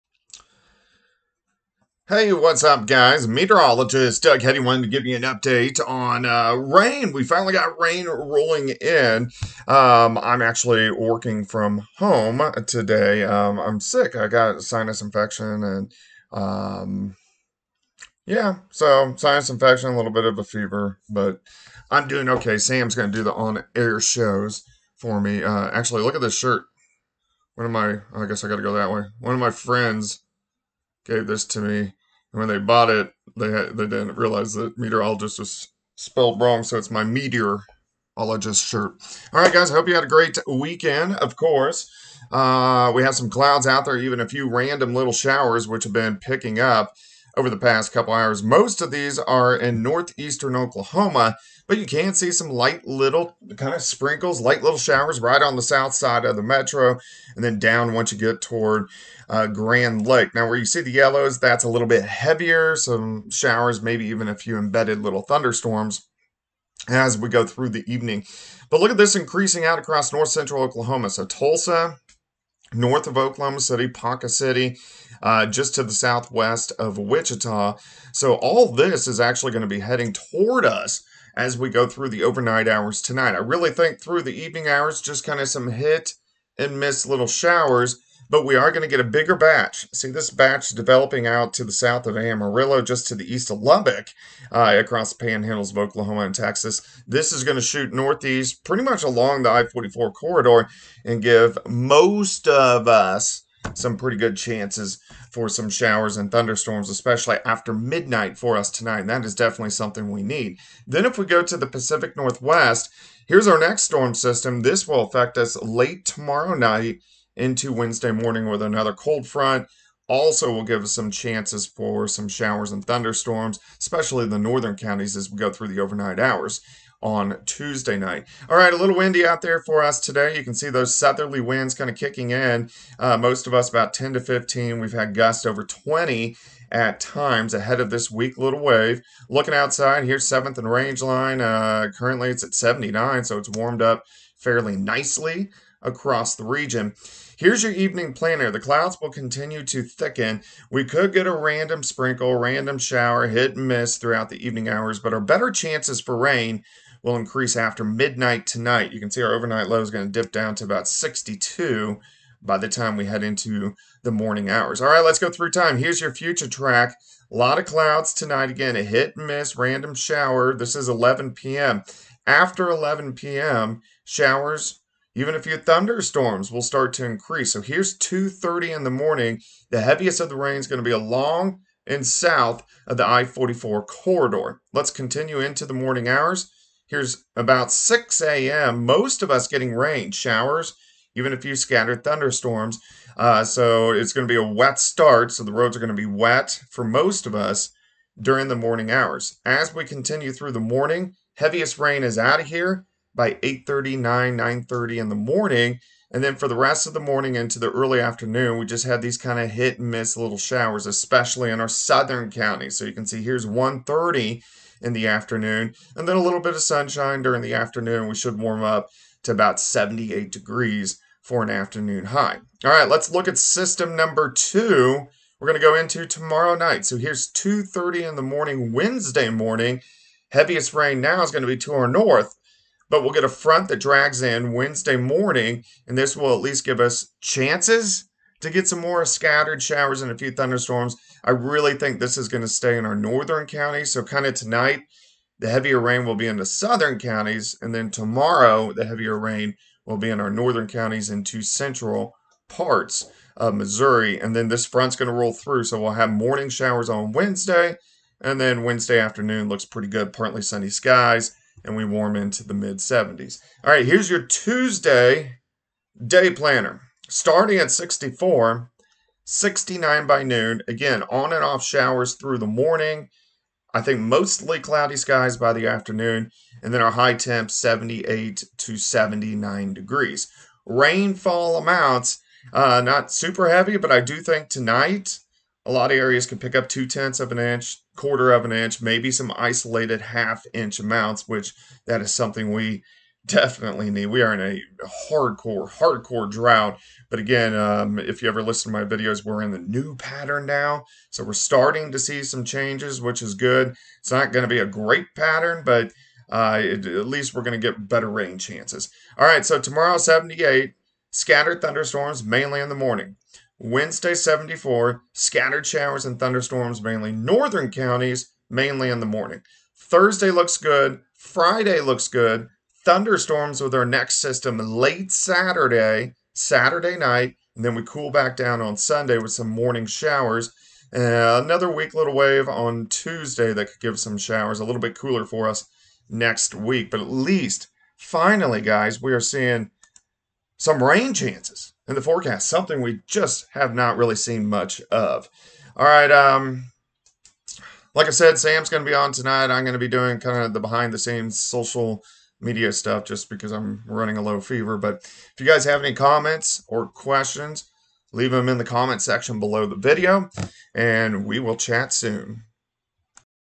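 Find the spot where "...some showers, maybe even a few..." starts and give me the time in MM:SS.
01:02.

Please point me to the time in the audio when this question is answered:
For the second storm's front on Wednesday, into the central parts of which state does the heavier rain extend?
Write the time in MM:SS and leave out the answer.
04:13.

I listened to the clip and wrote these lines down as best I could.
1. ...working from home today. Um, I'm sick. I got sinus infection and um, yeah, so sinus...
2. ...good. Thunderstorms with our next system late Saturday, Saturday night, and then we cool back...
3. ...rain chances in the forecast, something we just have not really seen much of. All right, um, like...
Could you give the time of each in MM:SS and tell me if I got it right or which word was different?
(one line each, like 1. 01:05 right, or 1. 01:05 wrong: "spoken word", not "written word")
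1. 00:10 right
2. 05:22 right
3. 05:40 right.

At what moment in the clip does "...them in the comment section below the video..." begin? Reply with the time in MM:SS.
05:58.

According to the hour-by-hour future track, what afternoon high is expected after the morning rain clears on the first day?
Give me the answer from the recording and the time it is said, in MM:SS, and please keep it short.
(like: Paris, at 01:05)
78 degrees, at 03:39.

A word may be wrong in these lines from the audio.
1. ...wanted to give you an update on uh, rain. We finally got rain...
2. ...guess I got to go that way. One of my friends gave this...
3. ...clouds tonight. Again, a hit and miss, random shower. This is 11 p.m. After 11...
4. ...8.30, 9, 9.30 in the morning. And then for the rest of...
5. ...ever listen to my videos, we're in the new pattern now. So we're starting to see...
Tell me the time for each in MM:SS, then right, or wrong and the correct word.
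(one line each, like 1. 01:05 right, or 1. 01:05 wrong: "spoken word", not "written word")
1. 00:04 right
2. 00:28 right
3. 02:47 right
4. 03:23 right
5. 04:58 right.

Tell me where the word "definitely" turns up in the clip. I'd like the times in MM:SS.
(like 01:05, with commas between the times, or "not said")
01:49, 04:53.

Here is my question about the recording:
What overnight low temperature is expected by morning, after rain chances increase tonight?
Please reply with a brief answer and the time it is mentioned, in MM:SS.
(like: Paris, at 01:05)
62, at 02:40.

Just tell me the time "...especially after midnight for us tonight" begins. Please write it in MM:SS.
01:46.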